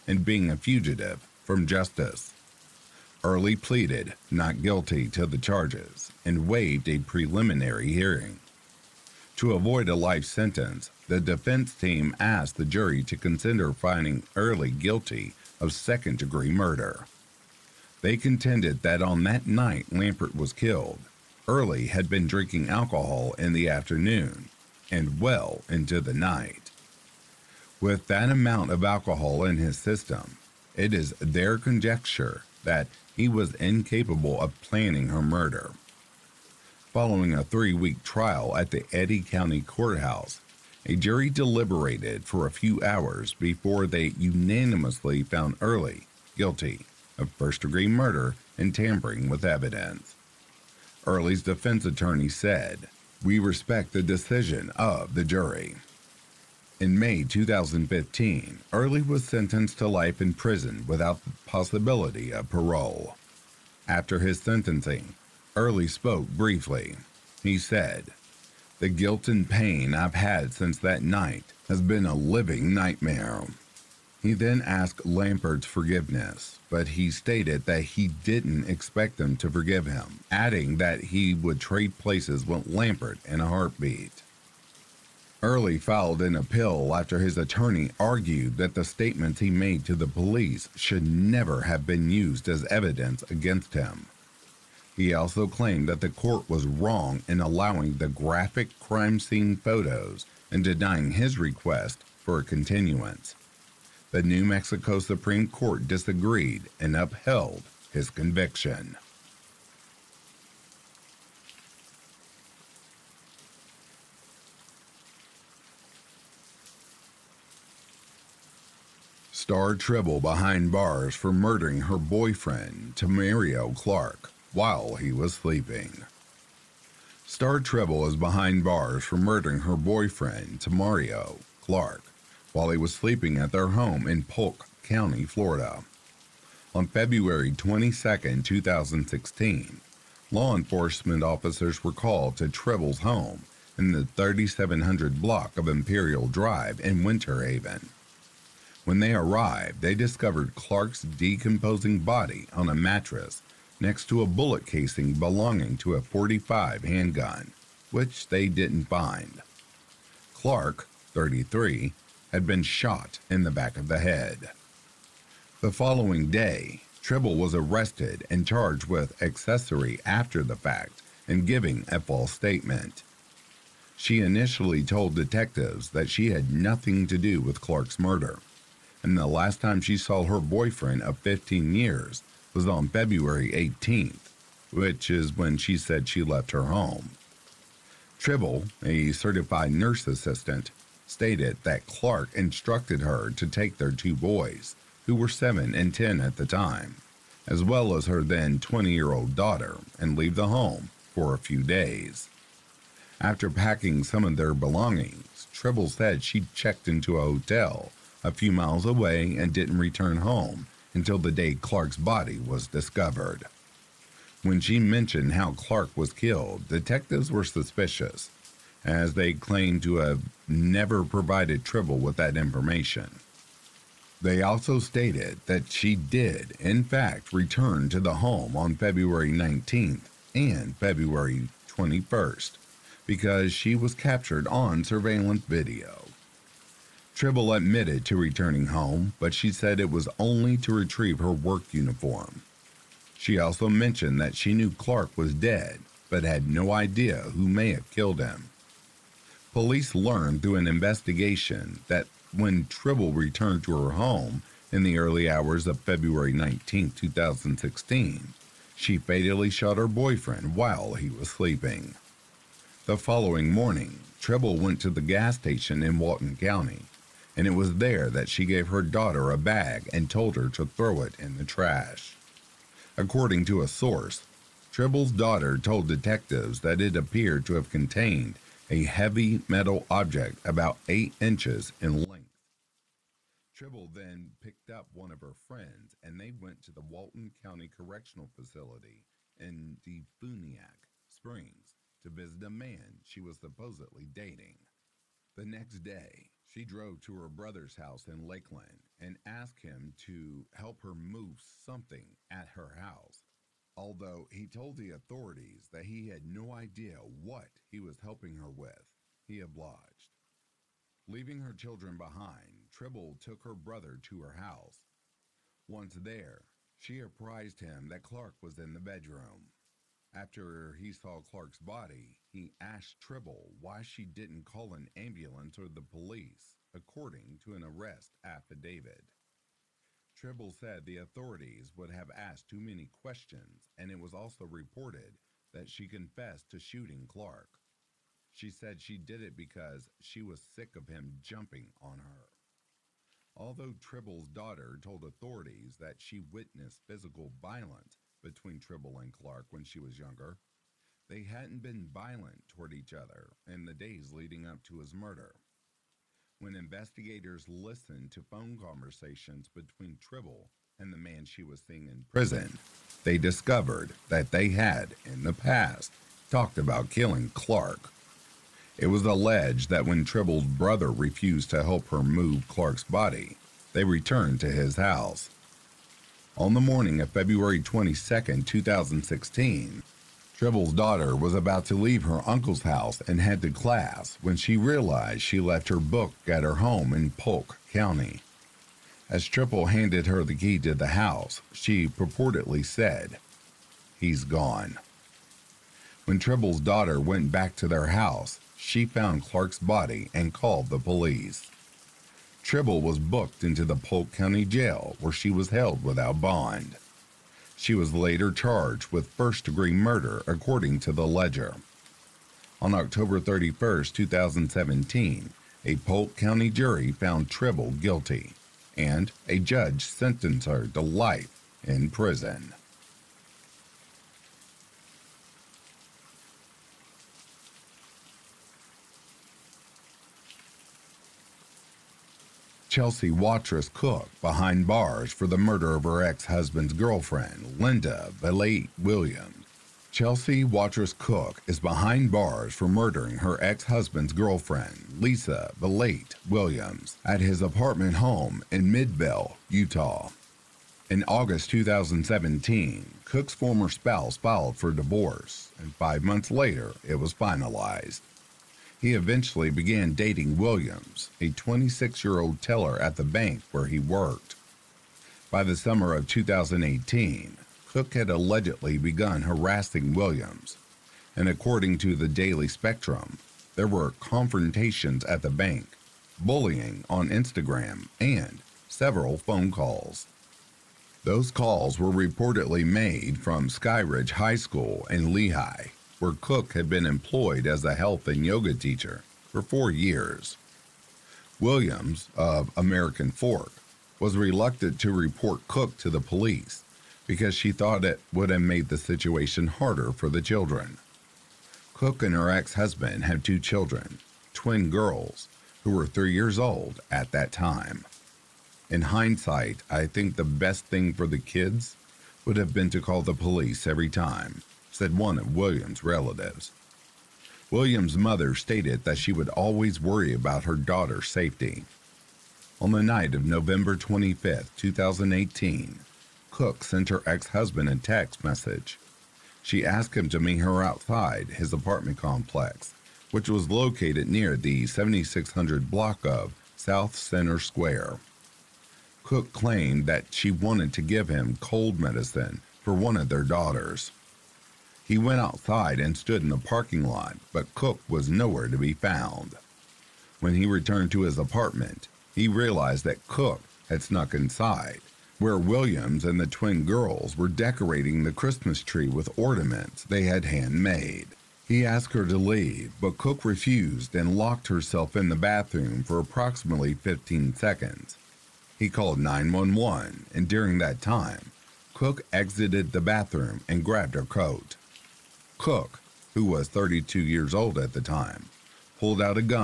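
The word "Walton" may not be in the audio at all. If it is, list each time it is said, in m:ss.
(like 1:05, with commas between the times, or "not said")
4:25, 4:46.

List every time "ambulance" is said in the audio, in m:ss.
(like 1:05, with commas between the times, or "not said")
5:24.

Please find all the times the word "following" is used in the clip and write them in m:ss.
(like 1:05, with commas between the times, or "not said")
0:36, 2:45, 4:22.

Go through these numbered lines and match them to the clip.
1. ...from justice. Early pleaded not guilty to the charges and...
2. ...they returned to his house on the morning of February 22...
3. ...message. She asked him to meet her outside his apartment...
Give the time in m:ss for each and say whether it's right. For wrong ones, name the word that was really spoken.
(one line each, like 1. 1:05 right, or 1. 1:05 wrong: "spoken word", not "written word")
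1. 0:01 right
2. 6:13 right
3. 8:48 right.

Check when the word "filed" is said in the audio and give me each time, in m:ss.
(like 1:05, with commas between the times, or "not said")
1:25, 7:34.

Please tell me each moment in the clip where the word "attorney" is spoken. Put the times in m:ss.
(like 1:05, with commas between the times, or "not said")
0:51, 1:27.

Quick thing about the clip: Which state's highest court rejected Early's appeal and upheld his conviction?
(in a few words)
New Mexico.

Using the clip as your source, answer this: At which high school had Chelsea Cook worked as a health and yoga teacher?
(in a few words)
Skyridge High School.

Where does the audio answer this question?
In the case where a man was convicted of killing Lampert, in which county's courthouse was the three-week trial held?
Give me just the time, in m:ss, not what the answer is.
0:38.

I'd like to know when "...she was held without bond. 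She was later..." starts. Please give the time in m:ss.
6:45.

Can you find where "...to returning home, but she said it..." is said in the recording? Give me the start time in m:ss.
3:58.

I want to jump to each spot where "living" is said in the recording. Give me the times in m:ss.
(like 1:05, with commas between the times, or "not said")
1:12.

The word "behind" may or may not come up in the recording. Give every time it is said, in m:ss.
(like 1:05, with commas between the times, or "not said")
2:00, 2:08, 5:11, 7:14, 7:21.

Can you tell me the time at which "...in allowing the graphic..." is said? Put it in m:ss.
1:37.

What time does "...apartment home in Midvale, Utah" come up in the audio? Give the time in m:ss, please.
7:27.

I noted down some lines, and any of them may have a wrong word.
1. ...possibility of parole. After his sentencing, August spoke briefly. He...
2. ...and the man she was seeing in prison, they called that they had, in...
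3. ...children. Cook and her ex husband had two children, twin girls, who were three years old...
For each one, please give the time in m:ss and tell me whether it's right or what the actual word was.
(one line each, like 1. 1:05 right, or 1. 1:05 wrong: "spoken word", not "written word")
1. 1:01 wrong: "Early", not "August"
2. 6:00 wrong: "discovered", not "called"
3. 8:20 right.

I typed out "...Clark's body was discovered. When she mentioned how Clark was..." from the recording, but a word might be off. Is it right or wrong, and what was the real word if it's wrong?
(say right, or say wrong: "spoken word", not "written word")
right.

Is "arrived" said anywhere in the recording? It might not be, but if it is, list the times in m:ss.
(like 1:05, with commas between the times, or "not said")
2:29.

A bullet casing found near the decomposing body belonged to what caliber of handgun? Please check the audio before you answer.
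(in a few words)
45.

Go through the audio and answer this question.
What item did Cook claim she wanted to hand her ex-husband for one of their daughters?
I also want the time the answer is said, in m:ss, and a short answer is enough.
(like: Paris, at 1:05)
cold medicine, at 9:01.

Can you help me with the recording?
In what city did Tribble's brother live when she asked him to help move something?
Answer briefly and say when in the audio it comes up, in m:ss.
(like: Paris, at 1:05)
Lakeland, at 4:58.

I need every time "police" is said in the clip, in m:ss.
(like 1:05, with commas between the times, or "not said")
1:30, 4:09, 5:25, 6:40, 8:15, 8:33.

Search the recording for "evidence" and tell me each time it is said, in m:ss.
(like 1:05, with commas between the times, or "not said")
0:49, 1:32.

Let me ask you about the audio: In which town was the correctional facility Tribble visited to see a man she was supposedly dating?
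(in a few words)
DeFuniak Springs.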